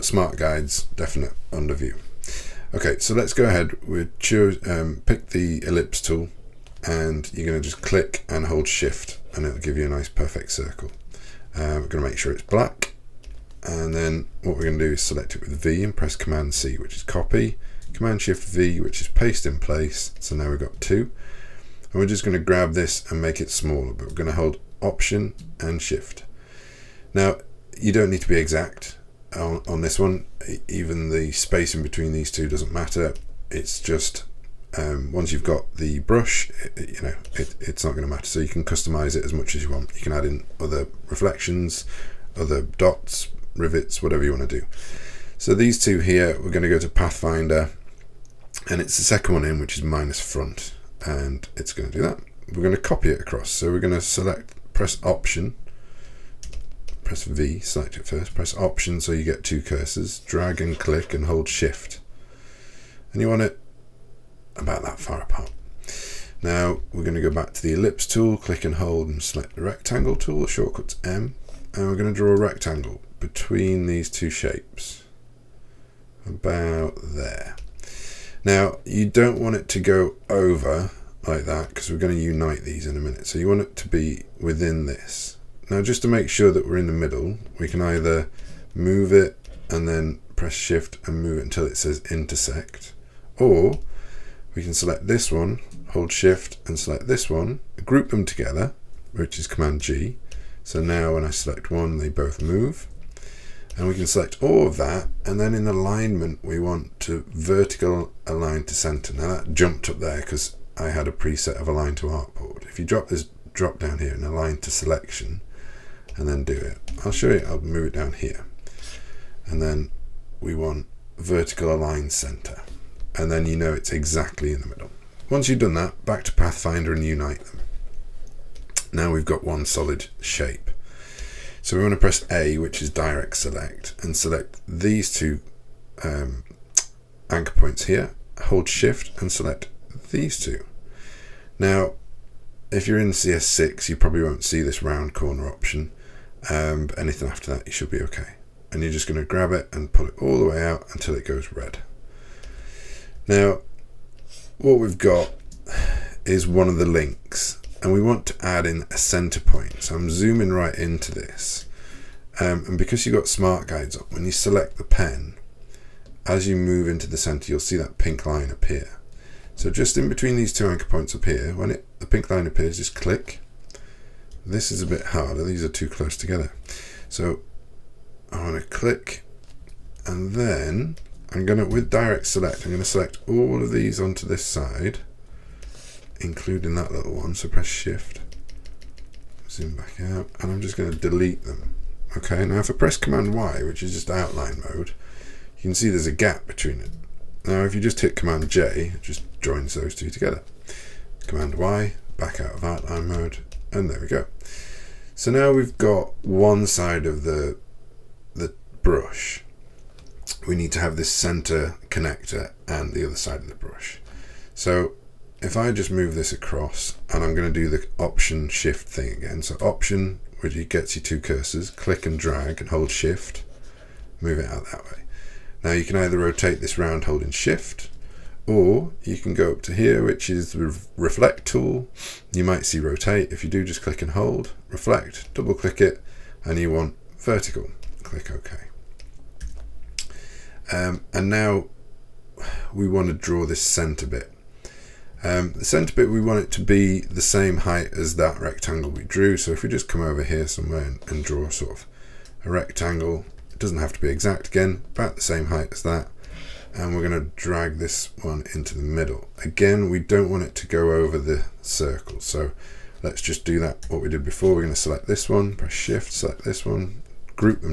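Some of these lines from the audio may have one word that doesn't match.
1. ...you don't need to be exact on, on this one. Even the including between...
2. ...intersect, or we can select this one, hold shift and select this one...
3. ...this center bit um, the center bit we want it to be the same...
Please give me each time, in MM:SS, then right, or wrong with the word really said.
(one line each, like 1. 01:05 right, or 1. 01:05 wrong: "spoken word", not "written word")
1. 00:27 wrong: "spacing", not "including"
2. 01:32 right
3. 04:03 right.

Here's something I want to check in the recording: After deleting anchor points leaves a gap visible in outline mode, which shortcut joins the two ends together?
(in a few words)
Command J.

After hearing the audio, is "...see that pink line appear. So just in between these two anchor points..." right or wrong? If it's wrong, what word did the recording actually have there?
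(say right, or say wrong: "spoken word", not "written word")
right.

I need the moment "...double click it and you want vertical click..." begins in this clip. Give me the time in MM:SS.
03:55.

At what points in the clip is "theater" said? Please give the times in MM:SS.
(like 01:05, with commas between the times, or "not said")
not said.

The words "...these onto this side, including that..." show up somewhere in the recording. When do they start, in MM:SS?
03:03.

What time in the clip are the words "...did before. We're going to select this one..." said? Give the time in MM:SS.
04:24.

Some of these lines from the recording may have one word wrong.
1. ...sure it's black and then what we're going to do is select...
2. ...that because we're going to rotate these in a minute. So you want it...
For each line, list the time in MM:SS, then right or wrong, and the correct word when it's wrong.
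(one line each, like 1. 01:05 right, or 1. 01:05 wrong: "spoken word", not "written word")
1. 00:12 right
2. 01:21 wrong: "unite", not "rotate".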